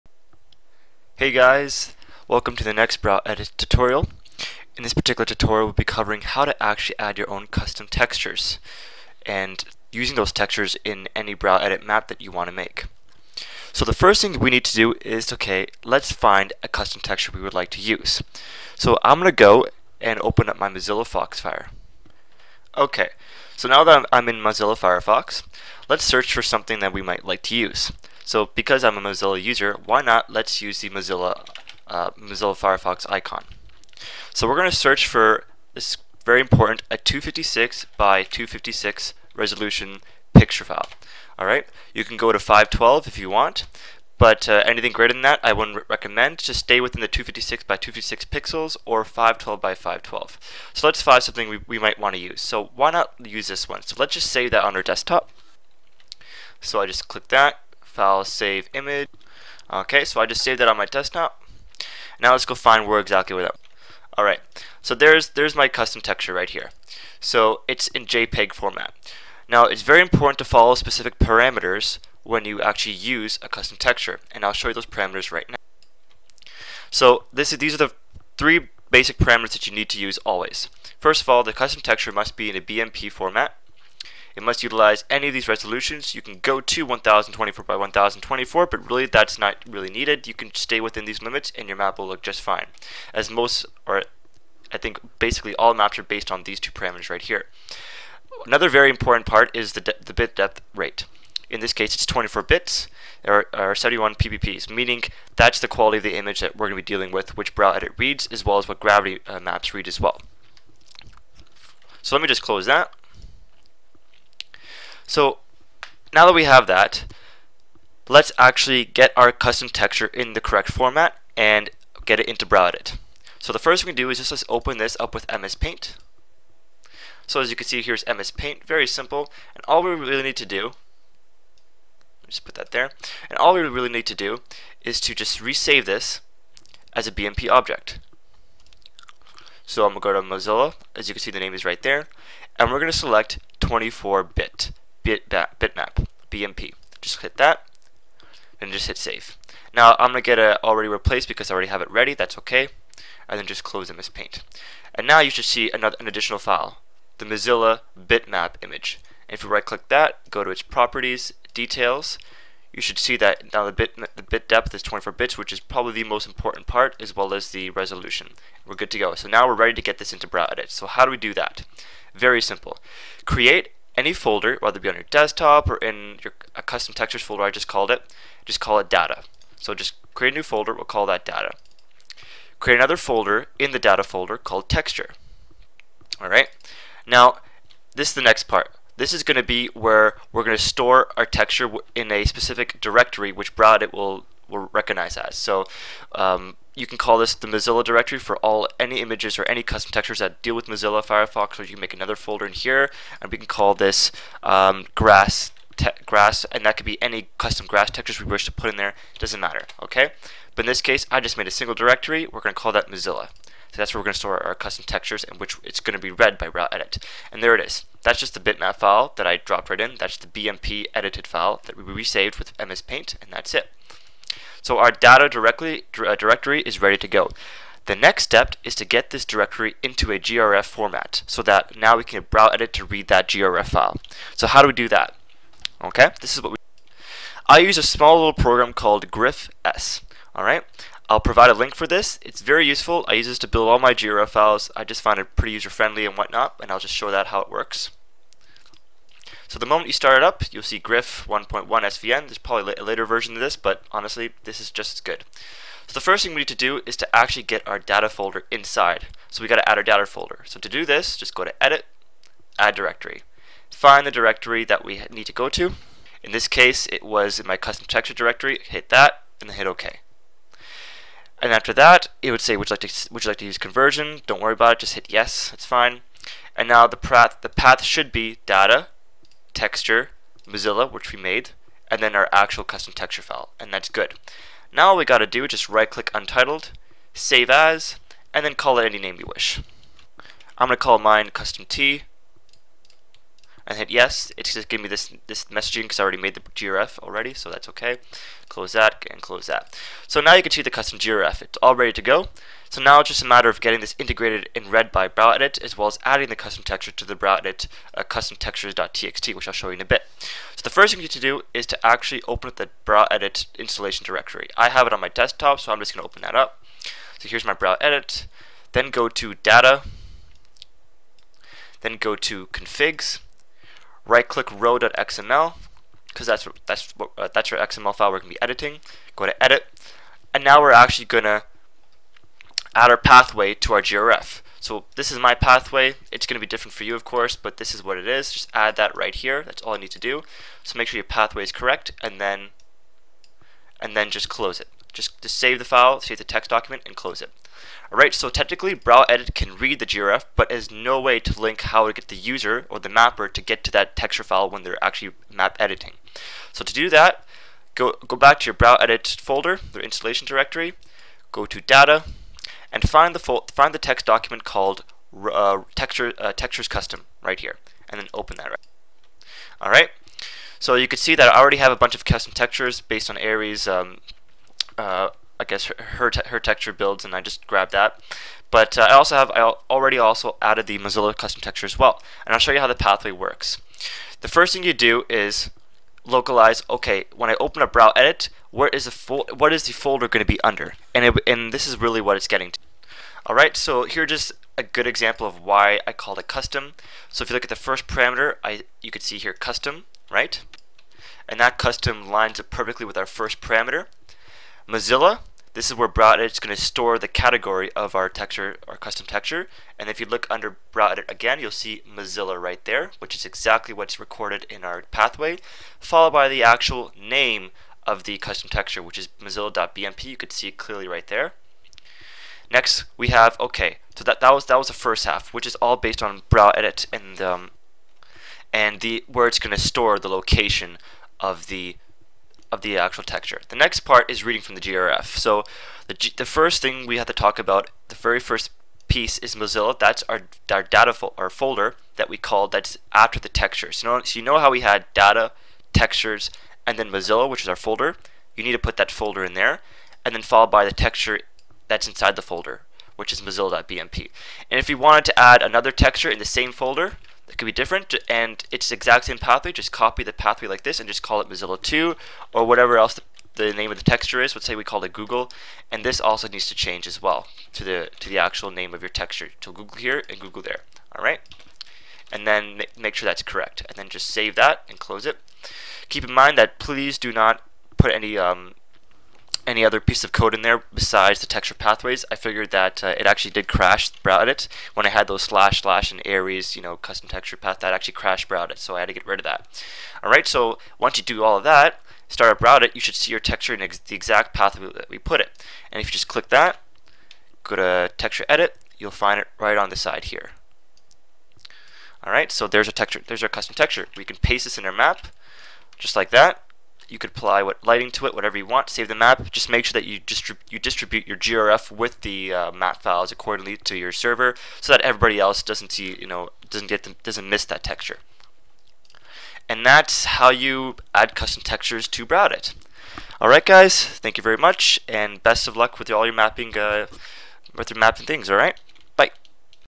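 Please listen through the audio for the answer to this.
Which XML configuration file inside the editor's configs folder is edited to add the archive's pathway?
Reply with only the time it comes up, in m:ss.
5:24.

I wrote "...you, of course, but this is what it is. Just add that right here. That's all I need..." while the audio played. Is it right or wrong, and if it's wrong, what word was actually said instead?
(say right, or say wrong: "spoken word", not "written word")
right.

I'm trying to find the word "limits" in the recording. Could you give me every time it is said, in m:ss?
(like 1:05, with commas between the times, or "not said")
1:31.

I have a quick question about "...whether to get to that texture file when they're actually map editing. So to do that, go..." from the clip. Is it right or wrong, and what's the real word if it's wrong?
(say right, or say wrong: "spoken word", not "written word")
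wrong: "mapper", not "whether".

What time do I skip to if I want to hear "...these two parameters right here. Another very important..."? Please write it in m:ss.
1:36.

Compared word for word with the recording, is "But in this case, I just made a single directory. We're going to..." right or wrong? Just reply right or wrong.
right.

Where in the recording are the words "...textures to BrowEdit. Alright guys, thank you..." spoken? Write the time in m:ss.
8:41.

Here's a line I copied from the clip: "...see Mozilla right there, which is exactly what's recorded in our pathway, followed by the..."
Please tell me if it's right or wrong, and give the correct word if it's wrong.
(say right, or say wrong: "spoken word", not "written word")
right.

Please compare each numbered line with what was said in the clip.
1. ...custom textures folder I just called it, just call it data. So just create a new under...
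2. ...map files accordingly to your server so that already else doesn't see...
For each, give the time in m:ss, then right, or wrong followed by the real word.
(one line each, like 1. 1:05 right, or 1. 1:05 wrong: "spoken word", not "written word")
1. 2:56 wrong: "folder", not "under"
2. 8:32 wrong: "everybody", not "already".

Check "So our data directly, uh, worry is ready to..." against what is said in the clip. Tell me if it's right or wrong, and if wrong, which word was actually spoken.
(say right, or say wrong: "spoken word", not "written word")
wrong: "directory", not "worry".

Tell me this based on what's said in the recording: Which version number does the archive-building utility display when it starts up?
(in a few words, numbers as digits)
1.1.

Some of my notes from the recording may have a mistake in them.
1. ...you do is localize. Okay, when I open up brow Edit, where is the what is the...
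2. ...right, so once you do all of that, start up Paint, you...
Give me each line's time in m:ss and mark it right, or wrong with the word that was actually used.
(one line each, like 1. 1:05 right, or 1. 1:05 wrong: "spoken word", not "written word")
1. 6:24 right
2. 8:10 wrong: "BrowEdit", not "Paint".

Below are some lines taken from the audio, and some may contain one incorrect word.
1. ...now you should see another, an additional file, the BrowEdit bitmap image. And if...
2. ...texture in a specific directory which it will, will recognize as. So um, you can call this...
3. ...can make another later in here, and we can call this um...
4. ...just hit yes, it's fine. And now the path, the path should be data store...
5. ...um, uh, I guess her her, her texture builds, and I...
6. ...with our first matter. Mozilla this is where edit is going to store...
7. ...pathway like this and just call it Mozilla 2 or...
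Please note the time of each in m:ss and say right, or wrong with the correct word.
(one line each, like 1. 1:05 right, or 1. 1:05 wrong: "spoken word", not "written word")
1. 2:35 wrong: "Mozilla", not "BrowEdit"
2. 3:11 right
3. 3:21 wrong: "folder", not "later"
4. 4:34 wrong: "texture", not "store"
5. 6:13 right
6. 6:42 wrong: "parameter", not "matter"
7. 7:40 right.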